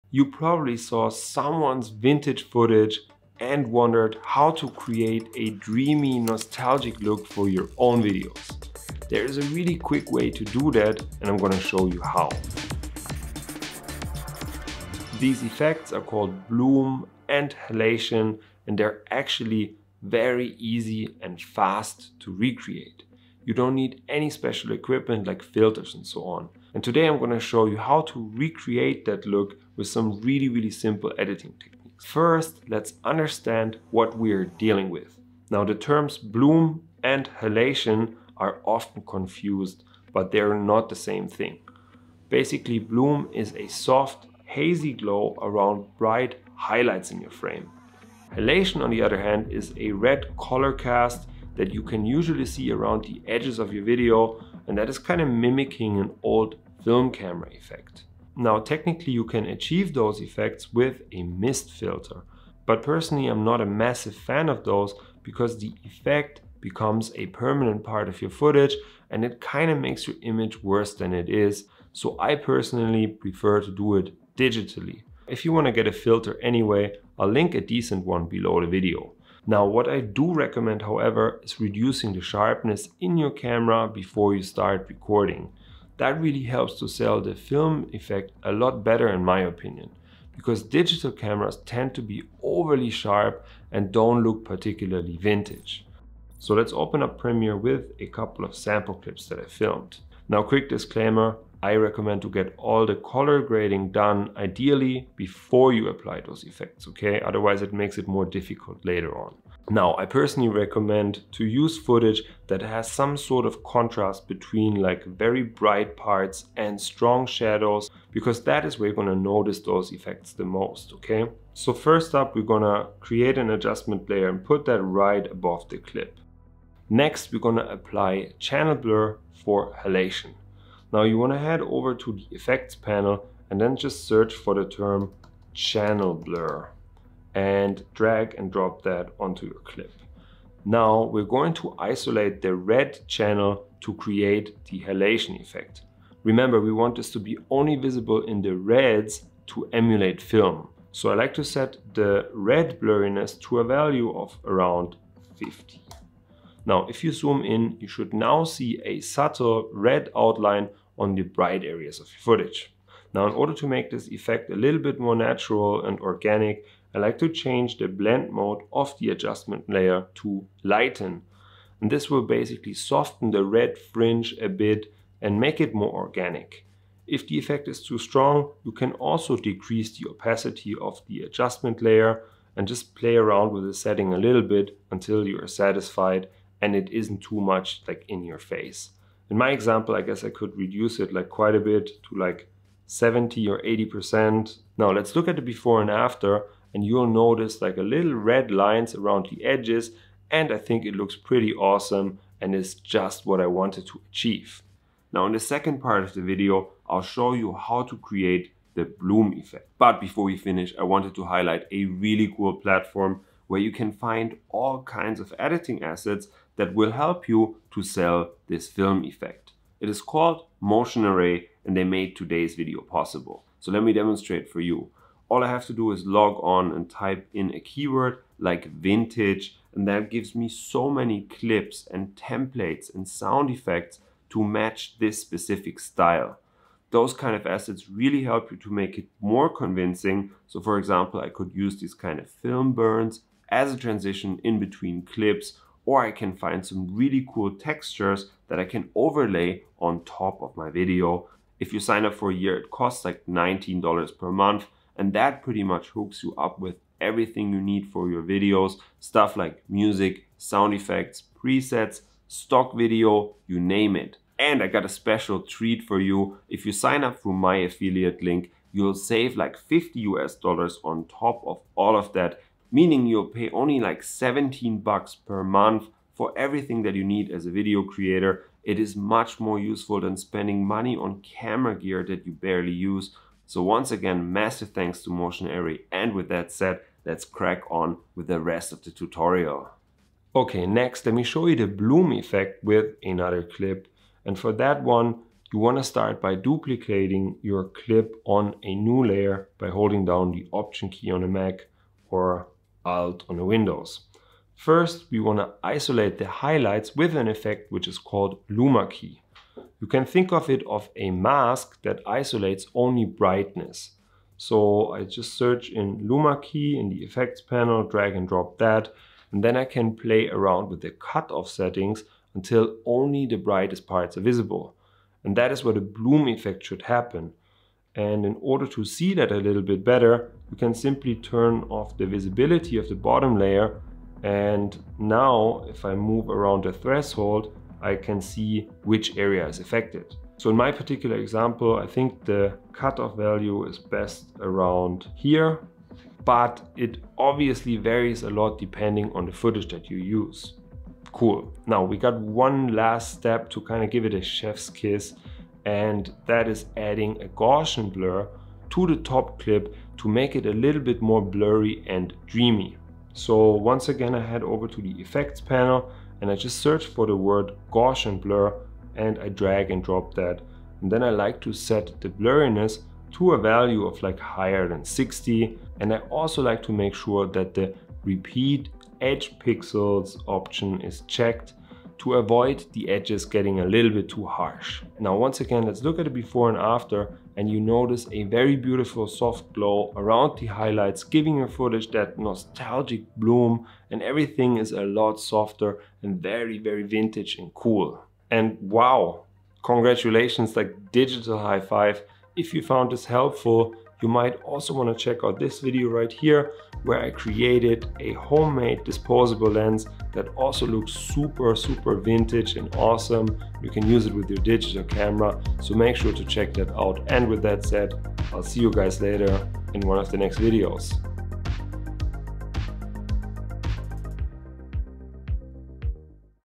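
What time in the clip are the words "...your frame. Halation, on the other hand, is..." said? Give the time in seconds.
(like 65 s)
47 s.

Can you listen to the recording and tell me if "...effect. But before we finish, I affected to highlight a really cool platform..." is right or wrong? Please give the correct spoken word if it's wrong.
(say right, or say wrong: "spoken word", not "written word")
wrong: "wanted", not "affected".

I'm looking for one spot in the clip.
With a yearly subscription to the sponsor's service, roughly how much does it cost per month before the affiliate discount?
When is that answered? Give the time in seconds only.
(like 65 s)
253 s.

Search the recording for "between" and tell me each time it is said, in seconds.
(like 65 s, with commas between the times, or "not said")
114 s, 244 s.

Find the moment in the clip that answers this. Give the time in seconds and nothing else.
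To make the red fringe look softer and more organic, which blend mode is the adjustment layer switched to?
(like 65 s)
170 s.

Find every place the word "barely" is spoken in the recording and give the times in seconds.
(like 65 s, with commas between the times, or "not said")
282 s.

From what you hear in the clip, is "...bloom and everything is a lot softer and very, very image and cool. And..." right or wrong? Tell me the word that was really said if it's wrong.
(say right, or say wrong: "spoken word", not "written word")
wrong: "vintage", not "image".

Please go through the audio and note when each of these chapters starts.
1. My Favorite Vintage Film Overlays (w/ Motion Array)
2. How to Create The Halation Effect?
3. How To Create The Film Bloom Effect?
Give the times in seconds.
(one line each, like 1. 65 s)
1. 203 s
2. 45 s
3. 293 s.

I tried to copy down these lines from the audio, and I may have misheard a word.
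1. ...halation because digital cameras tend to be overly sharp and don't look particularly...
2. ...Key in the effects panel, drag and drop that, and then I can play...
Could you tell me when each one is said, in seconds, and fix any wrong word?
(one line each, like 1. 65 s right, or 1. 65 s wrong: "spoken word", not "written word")
1. 89 s wrong: "opinion", not "halation"
2. 316 s right.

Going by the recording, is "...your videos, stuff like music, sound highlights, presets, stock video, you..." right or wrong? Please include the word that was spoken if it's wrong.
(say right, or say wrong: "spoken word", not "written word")
wrong: "effects", not "highlights".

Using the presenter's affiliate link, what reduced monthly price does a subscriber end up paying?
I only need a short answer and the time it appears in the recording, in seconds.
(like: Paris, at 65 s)
$17, at 274 s.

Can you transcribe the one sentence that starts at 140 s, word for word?
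Now we're going to isolate the red channel to create the halation effect.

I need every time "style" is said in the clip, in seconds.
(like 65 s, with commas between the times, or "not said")
235 s.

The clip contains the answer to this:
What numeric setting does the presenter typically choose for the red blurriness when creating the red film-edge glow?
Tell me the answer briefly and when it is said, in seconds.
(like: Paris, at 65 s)
50, at 154 s.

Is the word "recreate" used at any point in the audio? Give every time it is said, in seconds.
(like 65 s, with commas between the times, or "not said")
22 s, 28 s.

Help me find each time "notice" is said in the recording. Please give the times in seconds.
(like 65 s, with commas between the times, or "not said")
119 s, 197 s, 387 s.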